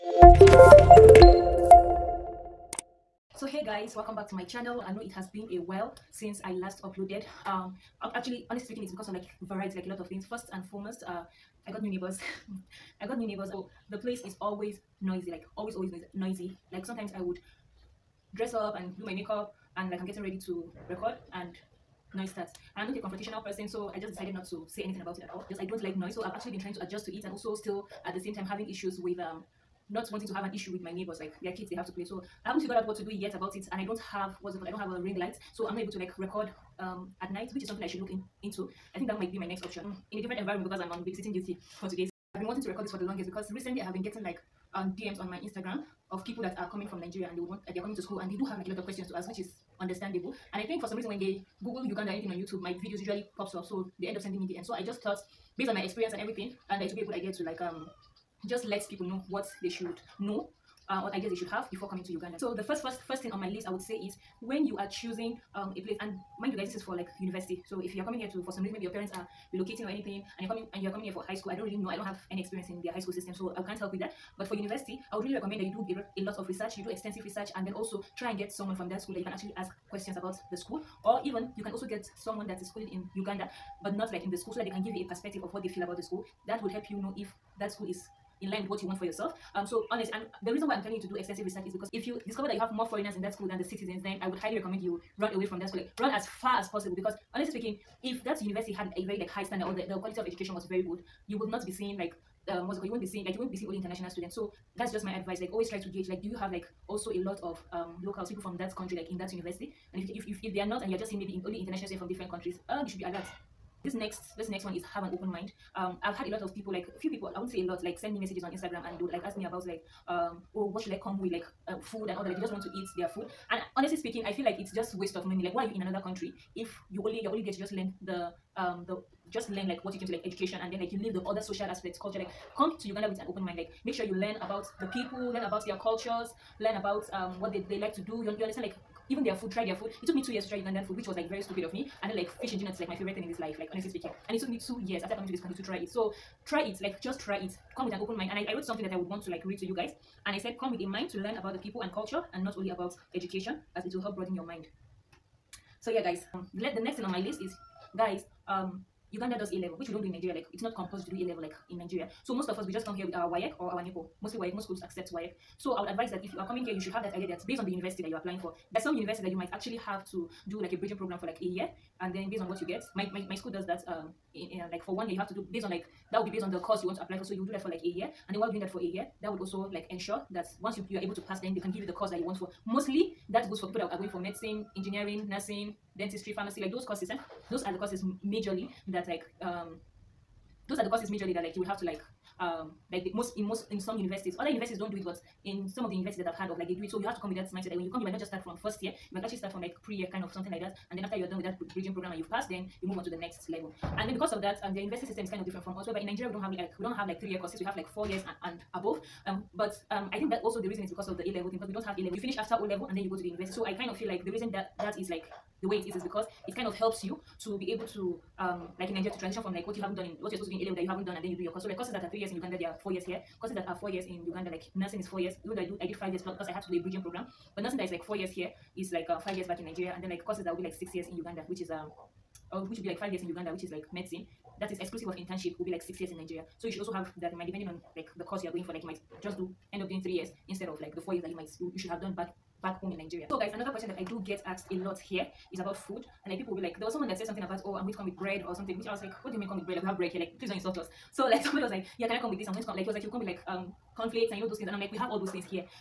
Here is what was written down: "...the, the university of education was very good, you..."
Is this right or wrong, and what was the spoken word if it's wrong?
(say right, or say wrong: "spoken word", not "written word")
wrong: "quality", not "university".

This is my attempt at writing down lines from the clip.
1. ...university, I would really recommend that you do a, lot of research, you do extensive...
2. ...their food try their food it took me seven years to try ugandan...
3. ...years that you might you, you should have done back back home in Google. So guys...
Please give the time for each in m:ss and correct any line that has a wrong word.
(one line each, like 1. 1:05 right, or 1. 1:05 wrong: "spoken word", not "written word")
1. 1:14 right
2. 2:19 wrong: "two", not "seven"
3. 4:01 wrong: "Nigeria", not "Google".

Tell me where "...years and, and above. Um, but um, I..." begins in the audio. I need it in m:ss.
3:28.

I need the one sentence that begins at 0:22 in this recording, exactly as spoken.
And I'm not a confrontational person, so I just decided not to say anything about it at all.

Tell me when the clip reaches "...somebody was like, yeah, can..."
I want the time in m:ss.
4:11.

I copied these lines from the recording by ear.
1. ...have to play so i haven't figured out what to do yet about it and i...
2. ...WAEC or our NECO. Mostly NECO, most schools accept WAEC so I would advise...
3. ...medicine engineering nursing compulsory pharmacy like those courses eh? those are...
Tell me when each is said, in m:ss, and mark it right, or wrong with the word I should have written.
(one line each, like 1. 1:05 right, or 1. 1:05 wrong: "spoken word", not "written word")
1. 0:31 right
2. 2:43 wrong: "WAEC", not "NECO"
3. 3:04 wrong: "dentistry", not "compulsory".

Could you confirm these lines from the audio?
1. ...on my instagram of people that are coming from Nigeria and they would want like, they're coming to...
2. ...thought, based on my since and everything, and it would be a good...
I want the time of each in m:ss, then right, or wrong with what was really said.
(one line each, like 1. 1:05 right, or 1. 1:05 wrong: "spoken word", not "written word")
1. 0:45 right
2. 0:55 wrong: "experience", not "since".